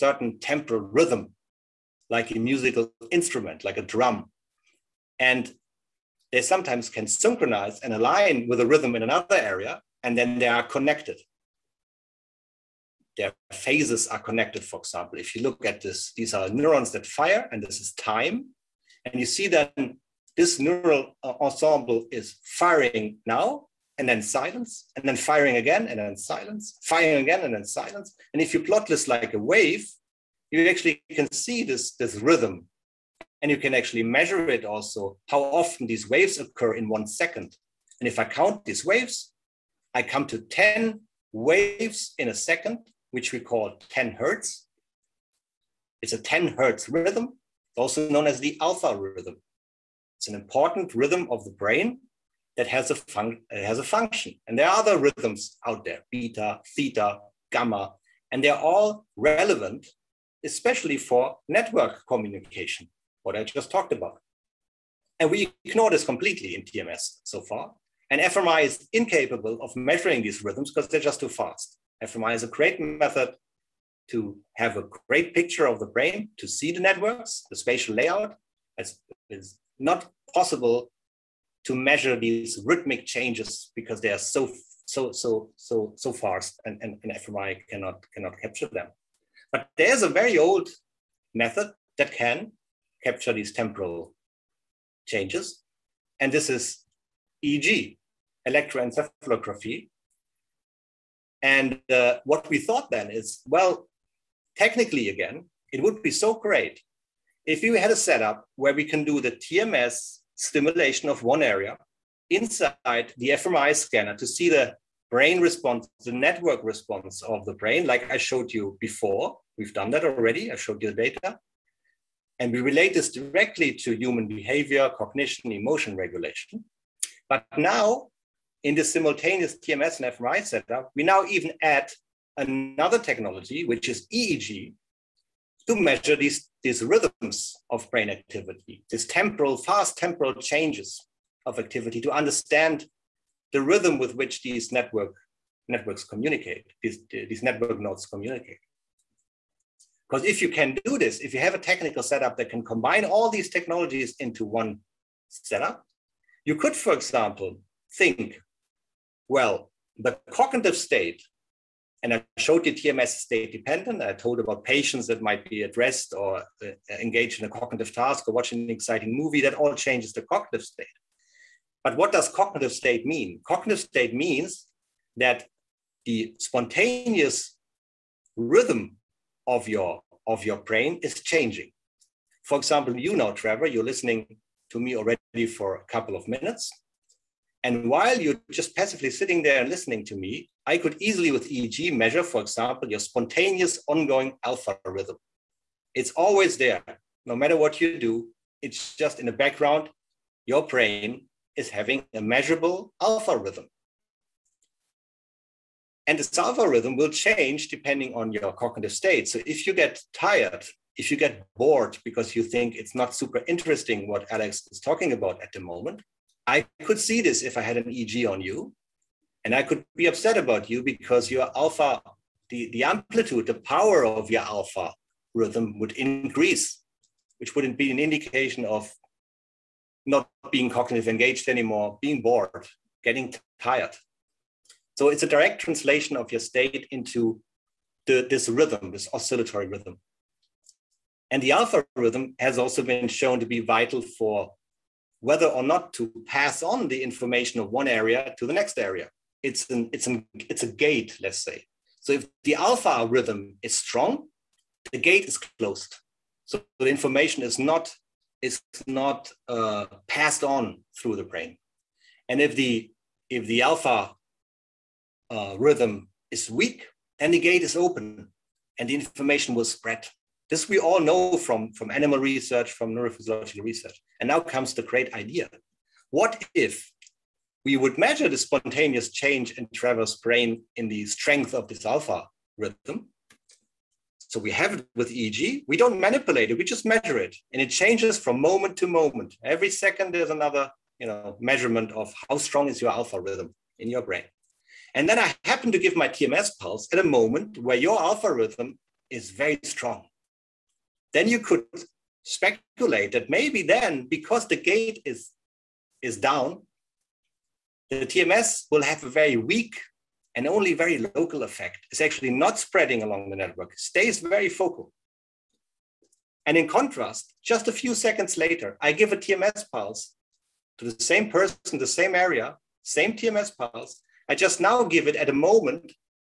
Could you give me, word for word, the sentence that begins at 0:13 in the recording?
Their phases are connected, for example.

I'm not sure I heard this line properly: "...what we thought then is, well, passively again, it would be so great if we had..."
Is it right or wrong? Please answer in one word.
wrong.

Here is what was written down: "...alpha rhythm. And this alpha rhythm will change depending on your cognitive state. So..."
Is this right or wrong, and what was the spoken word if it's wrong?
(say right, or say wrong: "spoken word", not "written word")
right.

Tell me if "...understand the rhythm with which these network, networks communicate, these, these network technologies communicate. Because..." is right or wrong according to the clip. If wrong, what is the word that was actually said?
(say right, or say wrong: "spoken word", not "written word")
wrong: "nodes", not "technologies".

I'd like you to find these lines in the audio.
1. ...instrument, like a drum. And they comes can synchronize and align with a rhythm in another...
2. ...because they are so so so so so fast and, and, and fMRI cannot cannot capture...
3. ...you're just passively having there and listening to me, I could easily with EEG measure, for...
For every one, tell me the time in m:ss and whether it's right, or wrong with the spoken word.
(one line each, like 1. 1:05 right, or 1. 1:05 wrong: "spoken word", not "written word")
1. 0:03 wrong: "sometimes", not "comes"
2. 1:23 right
3. 3:08 wrong: "sitting", not "having".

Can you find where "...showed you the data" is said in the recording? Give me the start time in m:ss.
2:00.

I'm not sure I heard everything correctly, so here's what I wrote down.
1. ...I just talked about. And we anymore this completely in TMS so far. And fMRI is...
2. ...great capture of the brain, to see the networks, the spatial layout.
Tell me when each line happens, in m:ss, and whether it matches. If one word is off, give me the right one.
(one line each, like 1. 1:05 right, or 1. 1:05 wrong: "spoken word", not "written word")
1. 1:03 wrong: "ignore", not "anymore"
2. 1:15 wrong: "picture", not "capture".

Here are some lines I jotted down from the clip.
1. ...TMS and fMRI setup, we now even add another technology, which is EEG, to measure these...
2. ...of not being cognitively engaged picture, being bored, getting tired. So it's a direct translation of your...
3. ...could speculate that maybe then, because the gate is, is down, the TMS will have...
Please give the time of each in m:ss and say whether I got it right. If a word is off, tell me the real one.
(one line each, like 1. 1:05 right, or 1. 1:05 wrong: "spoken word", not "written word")
1. 2:09 right
2. 3:48 wrong: "anymore", not "picture"
3. 5:01 right.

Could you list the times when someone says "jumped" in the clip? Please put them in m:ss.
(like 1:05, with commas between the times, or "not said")
not said.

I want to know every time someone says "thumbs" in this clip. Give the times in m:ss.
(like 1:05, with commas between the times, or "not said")
not said.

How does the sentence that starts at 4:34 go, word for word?
And now comes the great idea.